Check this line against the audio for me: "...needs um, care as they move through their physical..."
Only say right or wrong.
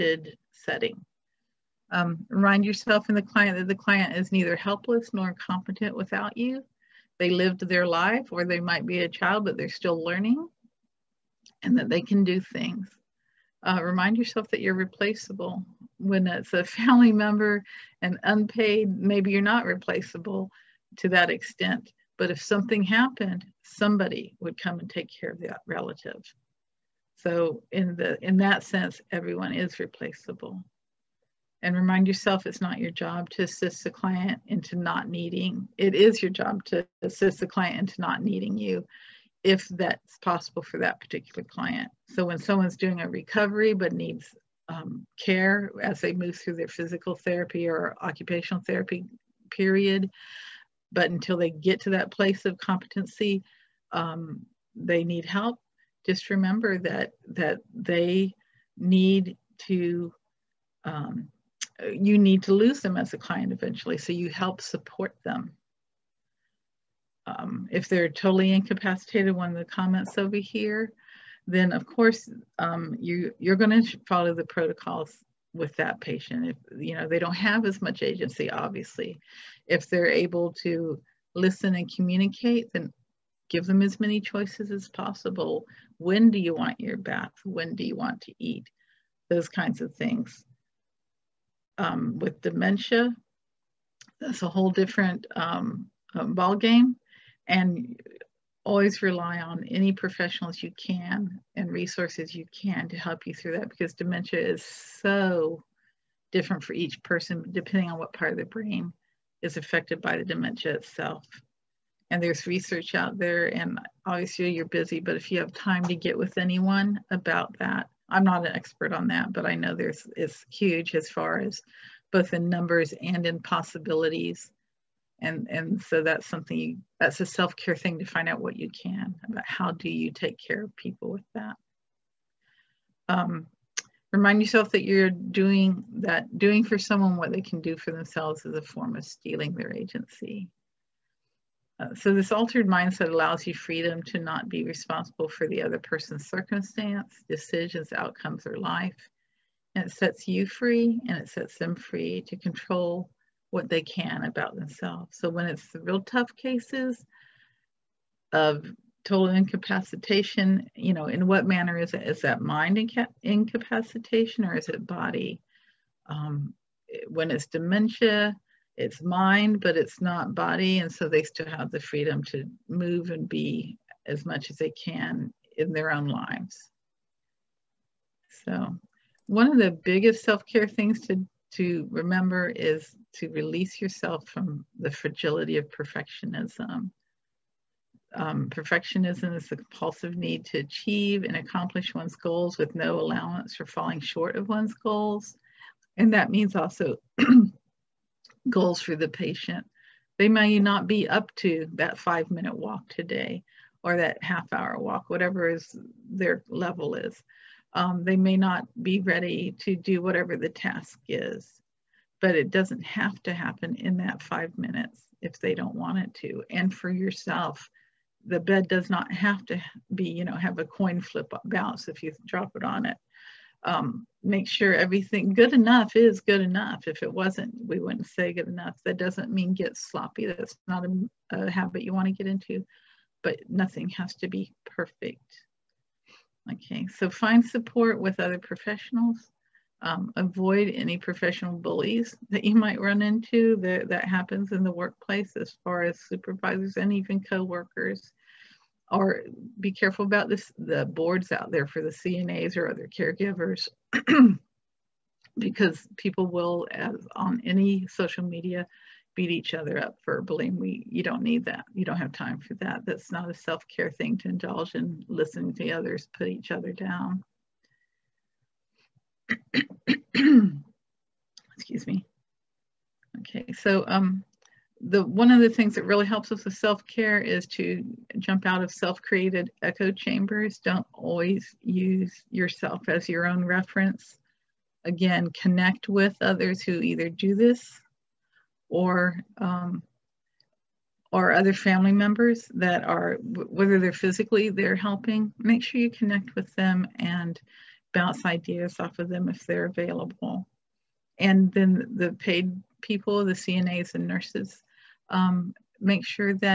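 right.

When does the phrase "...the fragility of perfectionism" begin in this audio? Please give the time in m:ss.
3:04.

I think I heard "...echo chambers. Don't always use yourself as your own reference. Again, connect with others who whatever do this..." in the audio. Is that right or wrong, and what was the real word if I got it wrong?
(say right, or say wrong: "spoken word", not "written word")
wrong: "either", not "whatever".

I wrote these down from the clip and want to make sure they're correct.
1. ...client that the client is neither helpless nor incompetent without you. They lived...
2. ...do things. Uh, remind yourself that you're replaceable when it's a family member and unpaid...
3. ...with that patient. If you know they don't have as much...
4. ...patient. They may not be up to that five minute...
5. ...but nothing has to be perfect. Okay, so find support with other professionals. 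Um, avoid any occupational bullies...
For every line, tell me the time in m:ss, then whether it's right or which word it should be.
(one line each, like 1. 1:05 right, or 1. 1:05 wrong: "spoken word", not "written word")
1. 0:03 right
2. 0:12 right
3. 1:15 right
4. 3:19 right
5. 3:53 wrong: "professional", not "occupational".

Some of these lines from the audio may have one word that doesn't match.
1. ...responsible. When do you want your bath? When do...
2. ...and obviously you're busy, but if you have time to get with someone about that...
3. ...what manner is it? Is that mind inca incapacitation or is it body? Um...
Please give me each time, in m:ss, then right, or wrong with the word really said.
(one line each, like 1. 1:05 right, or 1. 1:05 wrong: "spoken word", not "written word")
1. 1:24 wrong: "possible", not "responsible"
2. 1:53 wrong: "anyone", not "someone"
3. 2:41 right.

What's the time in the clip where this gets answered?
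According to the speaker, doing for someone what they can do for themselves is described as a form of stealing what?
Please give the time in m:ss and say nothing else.
2:19.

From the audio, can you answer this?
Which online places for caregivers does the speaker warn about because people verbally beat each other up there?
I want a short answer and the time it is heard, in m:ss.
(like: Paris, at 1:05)
the boards, at 4:10.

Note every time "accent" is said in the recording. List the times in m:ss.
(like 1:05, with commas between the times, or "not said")
not said.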